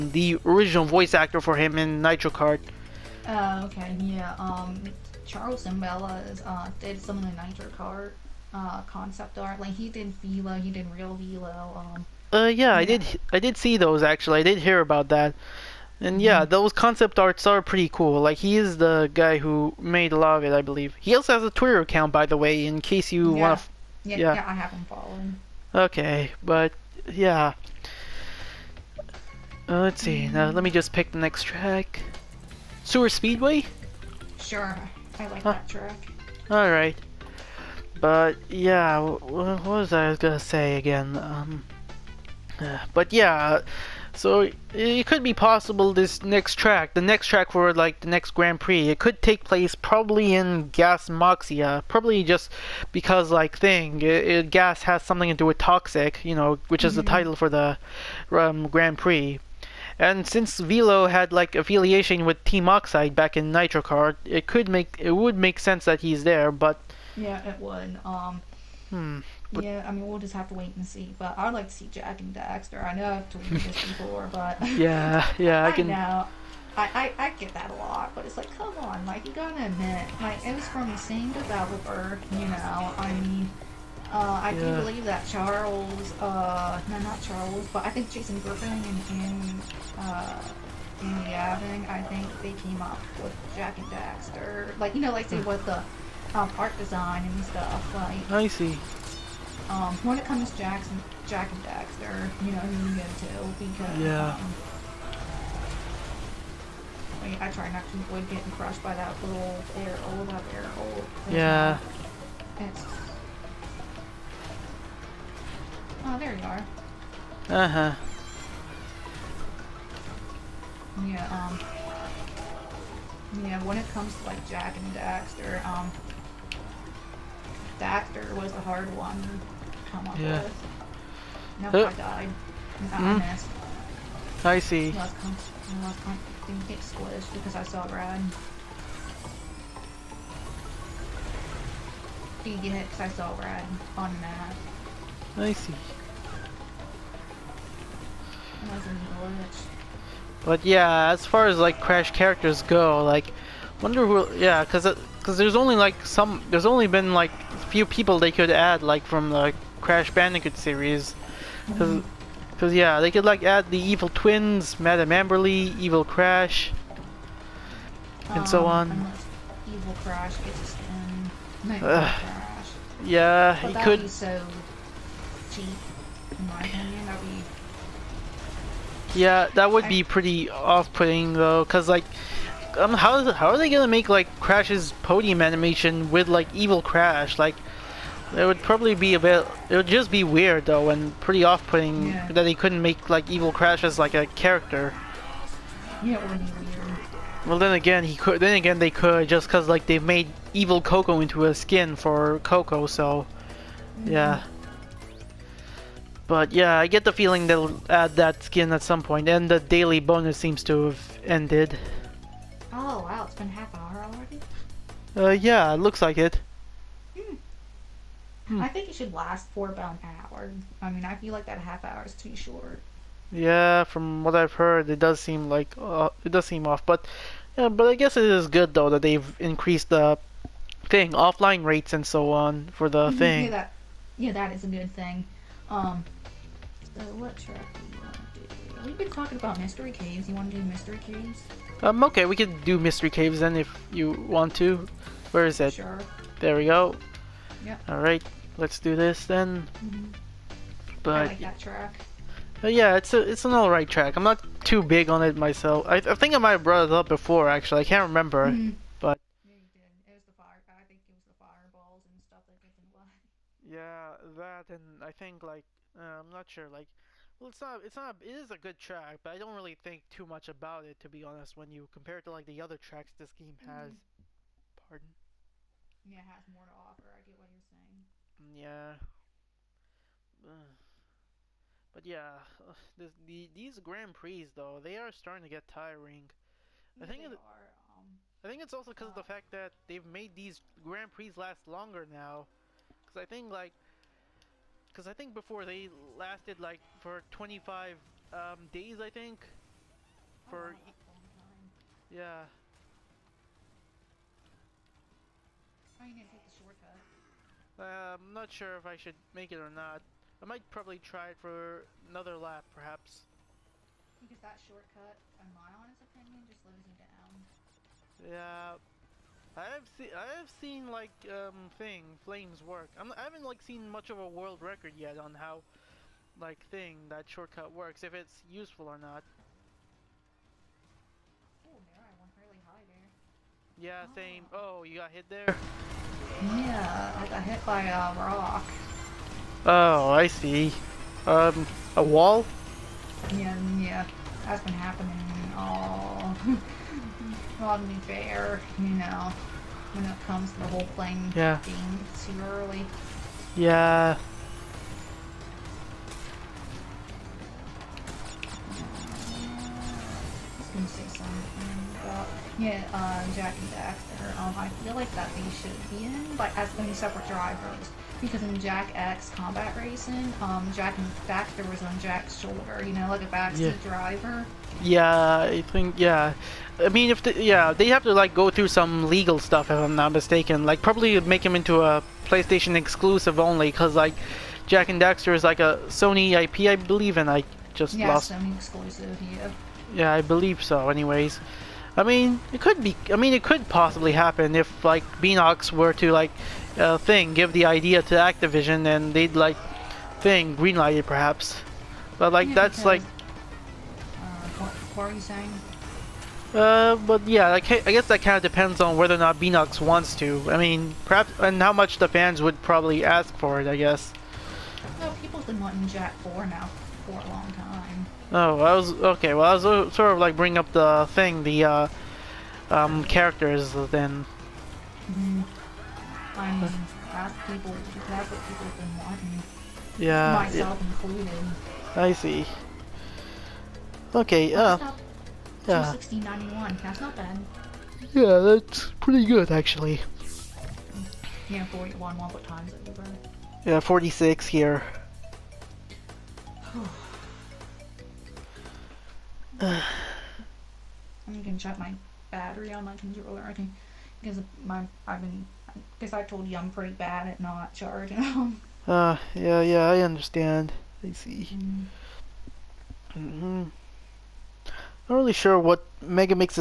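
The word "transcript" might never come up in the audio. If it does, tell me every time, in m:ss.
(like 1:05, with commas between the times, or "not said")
not said.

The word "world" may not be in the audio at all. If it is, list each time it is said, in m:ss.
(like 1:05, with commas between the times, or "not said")
5:24.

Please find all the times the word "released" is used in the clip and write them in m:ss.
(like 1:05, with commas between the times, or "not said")
not said.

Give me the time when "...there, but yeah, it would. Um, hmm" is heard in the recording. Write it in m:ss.
1:06.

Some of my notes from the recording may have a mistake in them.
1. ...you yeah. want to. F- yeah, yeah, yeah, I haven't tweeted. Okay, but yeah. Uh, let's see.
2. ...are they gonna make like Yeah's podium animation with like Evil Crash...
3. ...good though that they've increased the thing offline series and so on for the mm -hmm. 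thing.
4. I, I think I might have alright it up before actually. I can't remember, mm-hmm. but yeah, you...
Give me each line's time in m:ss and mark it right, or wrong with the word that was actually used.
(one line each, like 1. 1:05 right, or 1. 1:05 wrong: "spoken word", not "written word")
1. 0:23 wrong: "followed", not "tweeted"
2. 3:03 wrong: "Crash", not "Yeah"
3. 3:48 wrong: "rates", not "series"
4. 4:15 wrong: "brought", not "alright".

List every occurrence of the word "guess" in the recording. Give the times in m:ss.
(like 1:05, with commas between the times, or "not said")
3:47, 6:47, 6:53.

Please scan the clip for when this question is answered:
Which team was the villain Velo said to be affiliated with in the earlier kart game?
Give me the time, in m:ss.
1:02.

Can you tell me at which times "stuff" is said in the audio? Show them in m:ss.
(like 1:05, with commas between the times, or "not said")
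1:37, 4:22, 6:19.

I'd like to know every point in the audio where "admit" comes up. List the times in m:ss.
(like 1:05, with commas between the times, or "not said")
1:19.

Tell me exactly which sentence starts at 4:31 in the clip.
When you compare it to like the other tracks this game has, mm-hmm.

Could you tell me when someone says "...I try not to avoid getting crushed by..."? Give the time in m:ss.
1:47.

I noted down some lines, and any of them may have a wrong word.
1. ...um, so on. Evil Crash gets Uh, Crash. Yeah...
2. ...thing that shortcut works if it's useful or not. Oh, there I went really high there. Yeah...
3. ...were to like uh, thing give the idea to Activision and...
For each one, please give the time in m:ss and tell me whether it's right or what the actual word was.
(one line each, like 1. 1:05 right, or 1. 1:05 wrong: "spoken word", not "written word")
1. 2:48 right
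2. 5:26 right
3. 6:35 right.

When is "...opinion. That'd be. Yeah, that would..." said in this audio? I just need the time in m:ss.
2:56.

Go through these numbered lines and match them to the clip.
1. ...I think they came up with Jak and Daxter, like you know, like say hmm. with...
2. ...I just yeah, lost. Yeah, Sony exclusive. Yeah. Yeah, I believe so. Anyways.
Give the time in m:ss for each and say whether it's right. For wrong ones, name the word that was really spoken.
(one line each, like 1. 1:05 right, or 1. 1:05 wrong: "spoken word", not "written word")
1. 1:31 right
2. 6:27 right.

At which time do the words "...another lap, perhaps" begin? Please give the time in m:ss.
5:12.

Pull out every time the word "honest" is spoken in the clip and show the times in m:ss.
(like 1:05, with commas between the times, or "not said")
4:31, 5:15.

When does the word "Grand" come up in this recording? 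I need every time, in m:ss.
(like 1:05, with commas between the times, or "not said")
0:48, 0:58, 4:43, 4:50.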